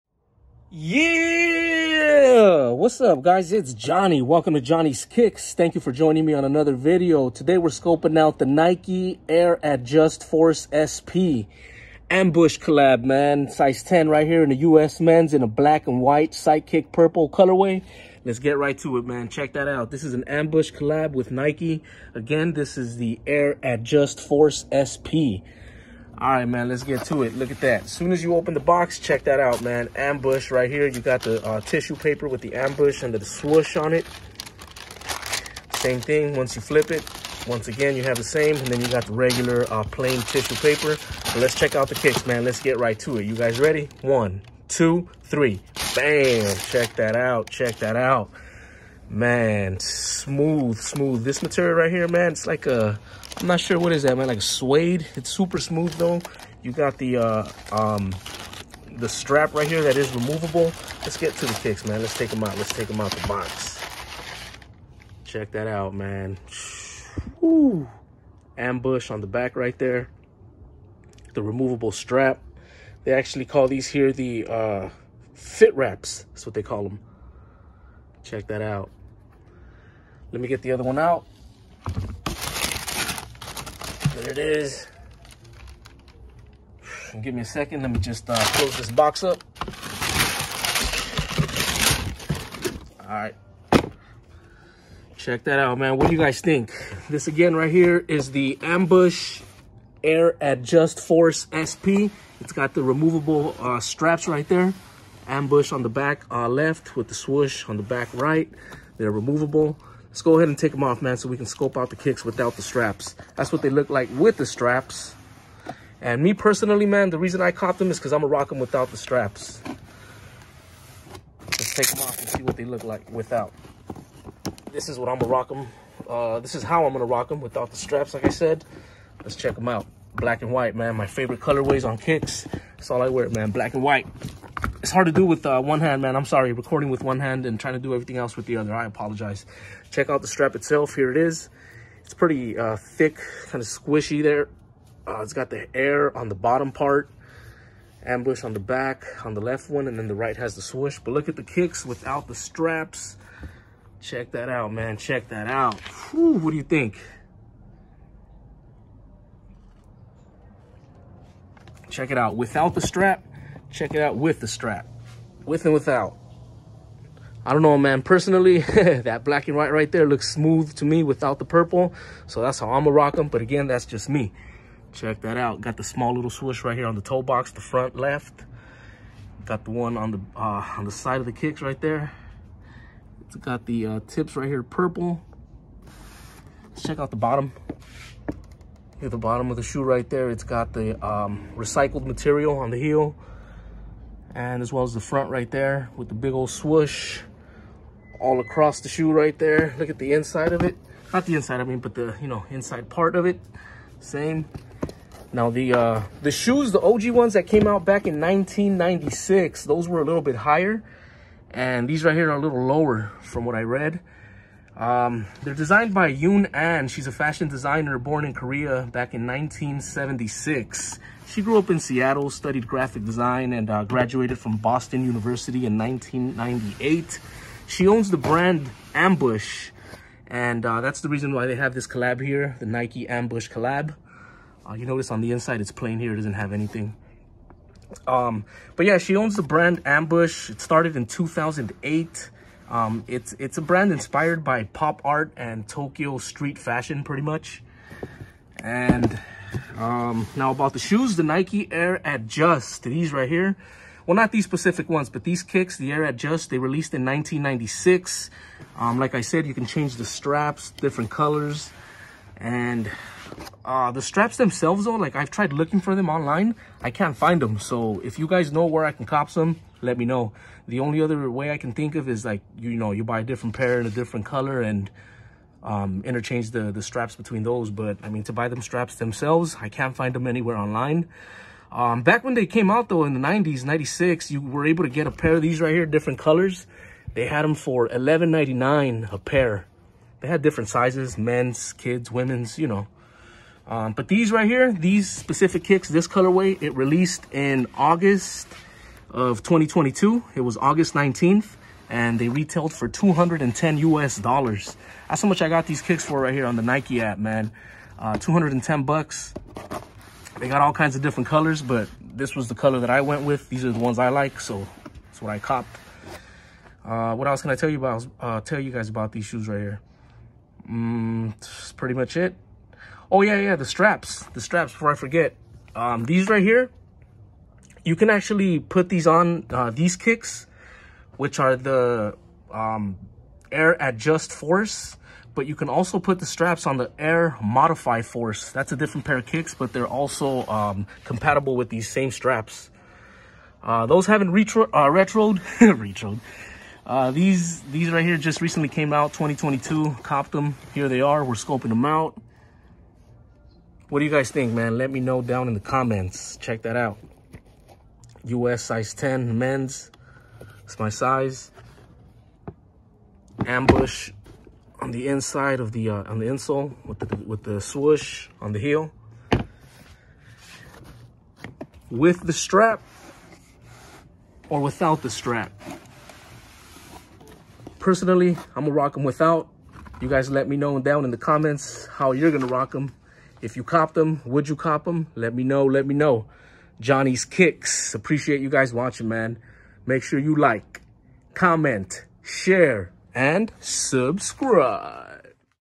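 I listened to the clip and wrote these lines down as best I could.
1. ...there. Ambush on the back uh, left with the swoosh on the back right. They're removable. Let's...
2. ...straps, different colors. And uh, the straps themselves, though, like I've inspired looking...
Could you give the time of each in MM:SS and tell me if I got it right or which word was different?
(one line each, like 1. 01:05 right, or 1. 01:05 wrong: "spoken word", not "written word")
1. 01:44 right
2. 04:20 wrong: "tried", not "inspired".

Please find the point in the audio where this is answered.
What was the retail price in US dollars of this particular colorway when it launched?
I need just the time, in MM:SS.
05:02.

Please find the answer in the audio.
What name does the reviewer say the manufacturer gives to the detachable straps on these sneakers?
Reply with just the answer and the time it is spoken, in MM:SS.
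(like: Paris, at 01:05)
fit wraps, at 01:15.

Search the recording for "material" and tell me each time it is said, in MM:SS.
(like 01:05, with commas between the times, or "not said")
00:51, 03:12.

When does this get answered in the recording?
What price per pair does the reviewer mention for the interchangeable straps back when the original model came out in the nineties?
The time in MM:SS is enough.
04:47.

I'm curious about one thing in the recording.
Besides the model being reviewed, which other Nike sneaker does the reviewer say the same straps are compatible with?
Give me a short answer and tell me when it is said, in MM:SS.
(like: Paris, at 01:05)
Air Modify Force, at 05:36.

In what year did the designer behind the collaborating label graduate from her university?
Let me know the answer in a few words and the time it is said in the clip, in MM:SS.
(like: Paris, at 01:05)
1998, at 03:45.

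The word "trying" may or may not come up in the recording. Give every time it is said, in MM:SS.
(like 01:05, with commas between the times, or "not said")
02:17.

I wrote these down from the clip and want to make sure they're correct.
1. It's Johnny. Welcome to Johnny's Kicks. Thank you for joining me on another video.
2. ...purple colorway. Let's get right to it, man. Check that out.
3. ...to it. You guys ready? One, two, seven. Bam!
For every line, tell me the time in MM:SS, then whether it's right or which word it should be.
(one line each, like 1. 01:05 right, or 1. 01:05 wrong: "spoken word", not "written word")
1. 00:03 right
2. 00:16 right
3. 00:42 wrong: "three", not "seven".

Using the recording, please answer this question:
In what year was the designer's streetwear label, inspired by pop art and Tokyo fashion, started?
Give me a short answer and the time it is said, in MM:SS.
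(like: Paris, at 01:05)
2008, at 04:01.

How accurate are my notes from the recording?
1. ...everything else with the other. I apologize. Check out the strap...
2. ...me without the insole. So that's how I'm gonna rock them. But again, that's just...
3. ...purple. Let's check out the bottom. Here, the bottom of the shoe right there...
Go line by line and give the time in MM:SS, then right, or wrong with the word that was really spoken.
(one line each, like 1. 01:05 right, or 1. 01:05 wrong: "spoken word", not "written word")
1. 02:17 right
2. 02:50 wrong: "purple", not "insole"
3. 03:04 right.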